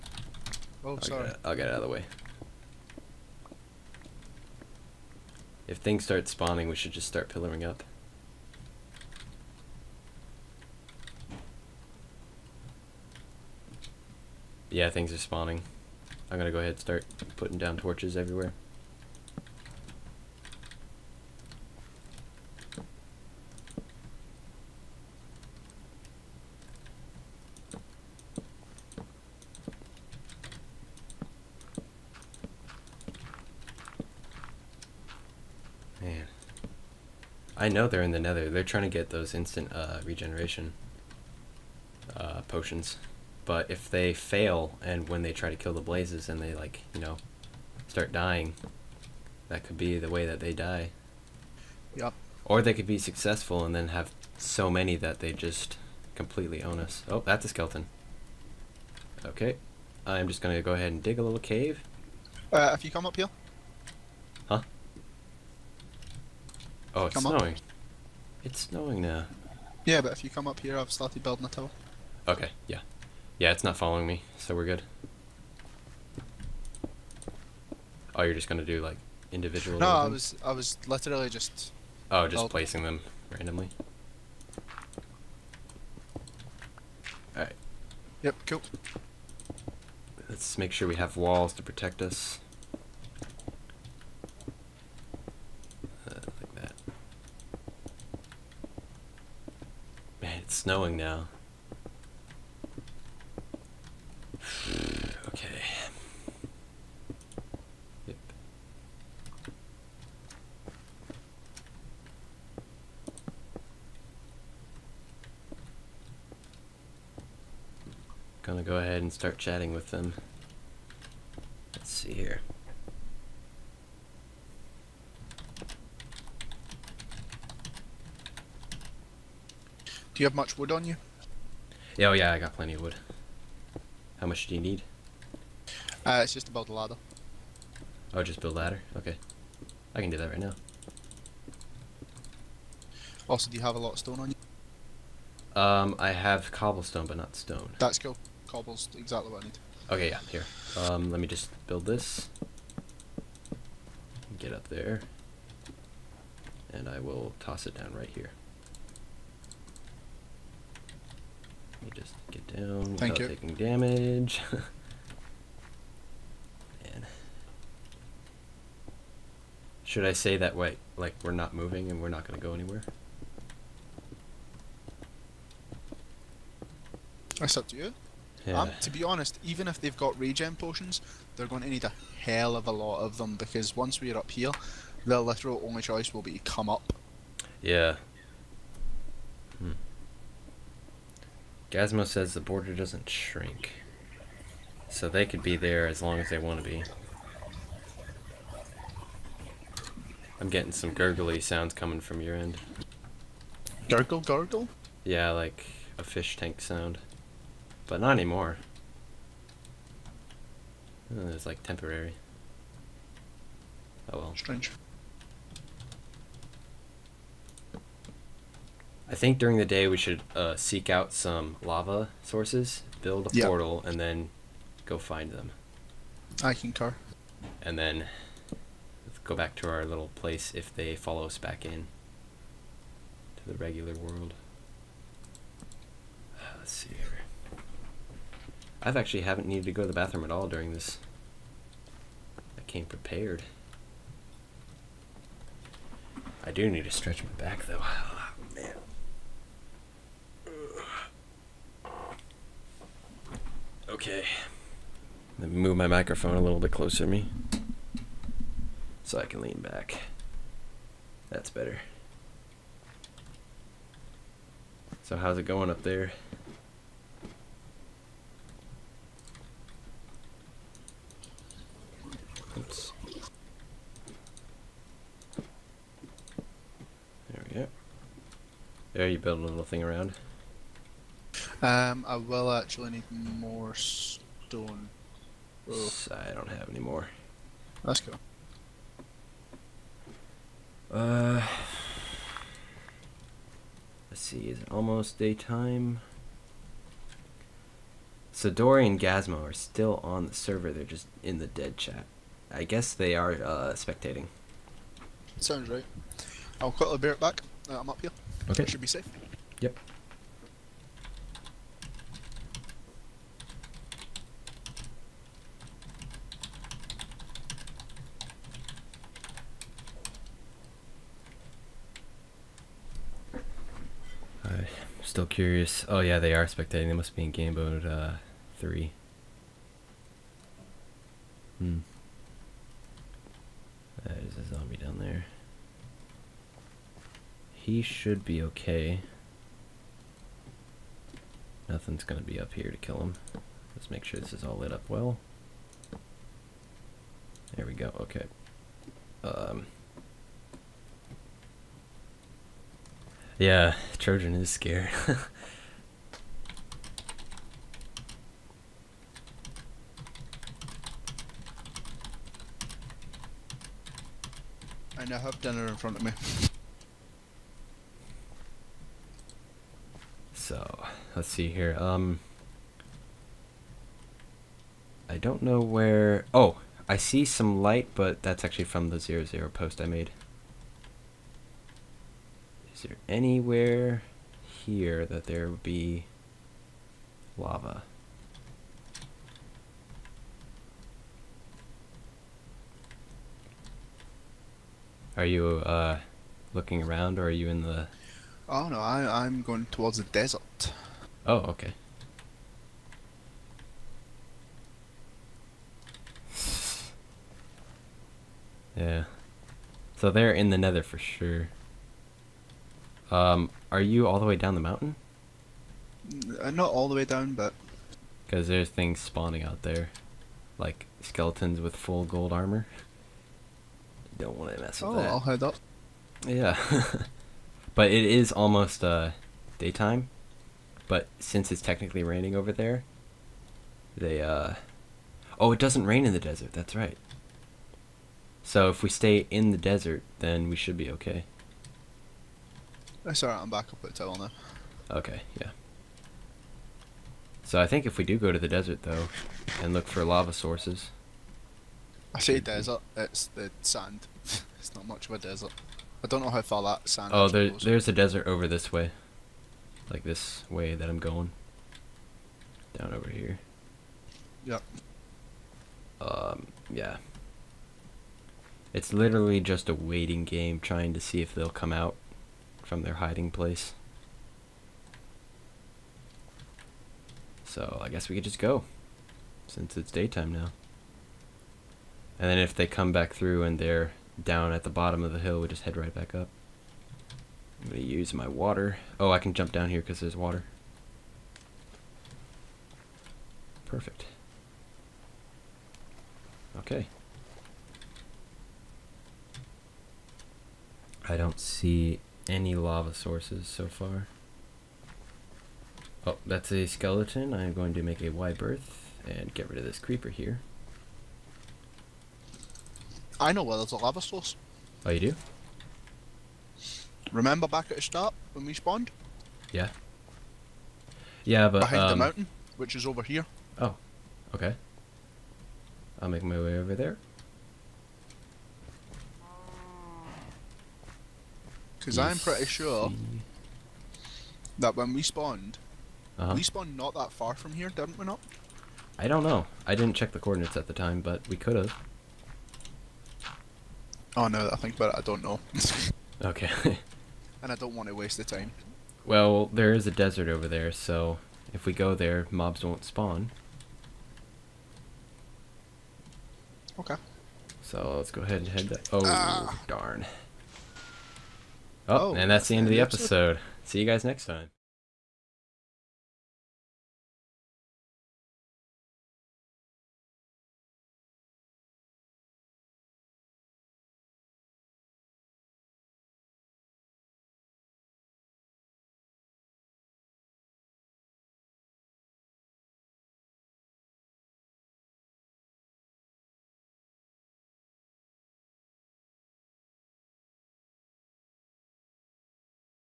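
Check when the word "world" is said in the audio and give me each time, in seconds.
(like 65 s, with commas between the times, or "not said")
233 s.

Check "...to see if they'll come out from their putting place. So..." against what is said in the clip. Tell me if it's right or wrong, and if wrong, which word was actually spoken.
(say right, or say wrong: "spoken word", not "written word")
wrong: "hiding", not "putting".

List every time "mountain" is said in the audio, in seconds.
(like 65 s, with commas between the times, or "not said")
414 s, 521 s.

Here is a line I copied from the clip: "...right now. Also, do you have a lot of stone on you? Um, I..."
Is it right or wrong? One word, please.
right.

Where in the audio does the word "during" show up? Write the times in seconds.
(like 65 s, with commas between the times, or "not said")
219 s, 240 s.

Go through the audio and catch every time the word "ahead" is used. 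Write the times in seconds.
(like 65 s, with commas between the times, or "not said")
16 s, 60 s, 118 s, 558 s.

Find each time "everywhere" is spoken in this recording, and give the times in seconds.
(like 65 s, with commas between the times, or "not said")
18 s.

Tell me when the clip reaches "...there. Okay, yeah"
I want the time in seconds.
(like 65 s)
444 s.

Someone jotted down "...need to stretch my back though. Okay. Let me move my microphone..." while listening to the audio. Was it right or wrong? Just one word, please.
right.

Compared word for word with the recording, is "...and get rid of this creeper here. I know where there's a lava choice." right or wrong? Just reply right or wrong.
wrong.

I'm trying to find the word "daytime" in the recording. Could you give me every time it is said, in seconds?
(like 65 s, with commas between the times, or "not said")
295 s, 429 s, 479 s.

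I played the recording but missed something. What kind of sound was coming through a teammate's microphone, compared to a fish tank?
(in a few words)
gurgly sounds.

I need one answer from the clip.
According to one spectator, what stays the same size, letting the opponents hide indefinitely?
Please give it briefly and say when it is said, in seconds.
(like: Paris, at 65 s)
the border, at 192 s.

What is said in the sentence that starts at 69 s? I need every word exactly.
Yeah, but if you come up here, I've started building a tower.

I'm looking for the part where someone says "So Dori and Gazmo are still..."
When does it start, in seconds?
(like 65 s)
298 s.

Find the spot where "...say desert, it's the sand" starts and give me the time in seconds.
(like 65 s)
452 s.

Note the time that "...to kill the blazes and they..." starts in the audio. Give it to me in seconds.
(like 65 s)
45 s.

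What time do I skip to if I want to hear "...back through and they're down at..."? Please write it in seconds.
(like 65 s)
482 s.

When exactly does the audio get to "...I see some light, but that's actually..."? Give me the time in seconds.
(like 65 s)
376 s.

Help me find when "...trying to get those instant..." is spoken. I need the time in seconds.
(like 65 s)
38 s.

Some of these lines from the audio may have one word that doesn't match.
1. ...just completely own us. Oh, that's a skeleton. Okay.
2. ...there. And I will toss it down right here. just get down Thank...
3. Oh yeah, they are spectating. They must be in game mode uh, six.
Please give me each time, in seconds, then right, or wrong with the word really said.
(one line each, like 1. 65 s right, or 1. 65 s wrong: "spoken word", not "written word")
1. 55 s right
2. 154 s right
3. 325 s wrong: "three", not "six".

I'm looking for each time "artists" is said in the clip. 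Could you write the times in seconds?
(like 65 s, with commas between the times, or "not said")
not said.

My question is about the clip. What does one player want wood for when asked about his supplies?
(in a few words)
a ladder.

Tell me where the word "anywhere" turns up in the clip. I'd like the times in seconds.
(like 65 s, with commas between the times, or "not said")
172 s, 383 s.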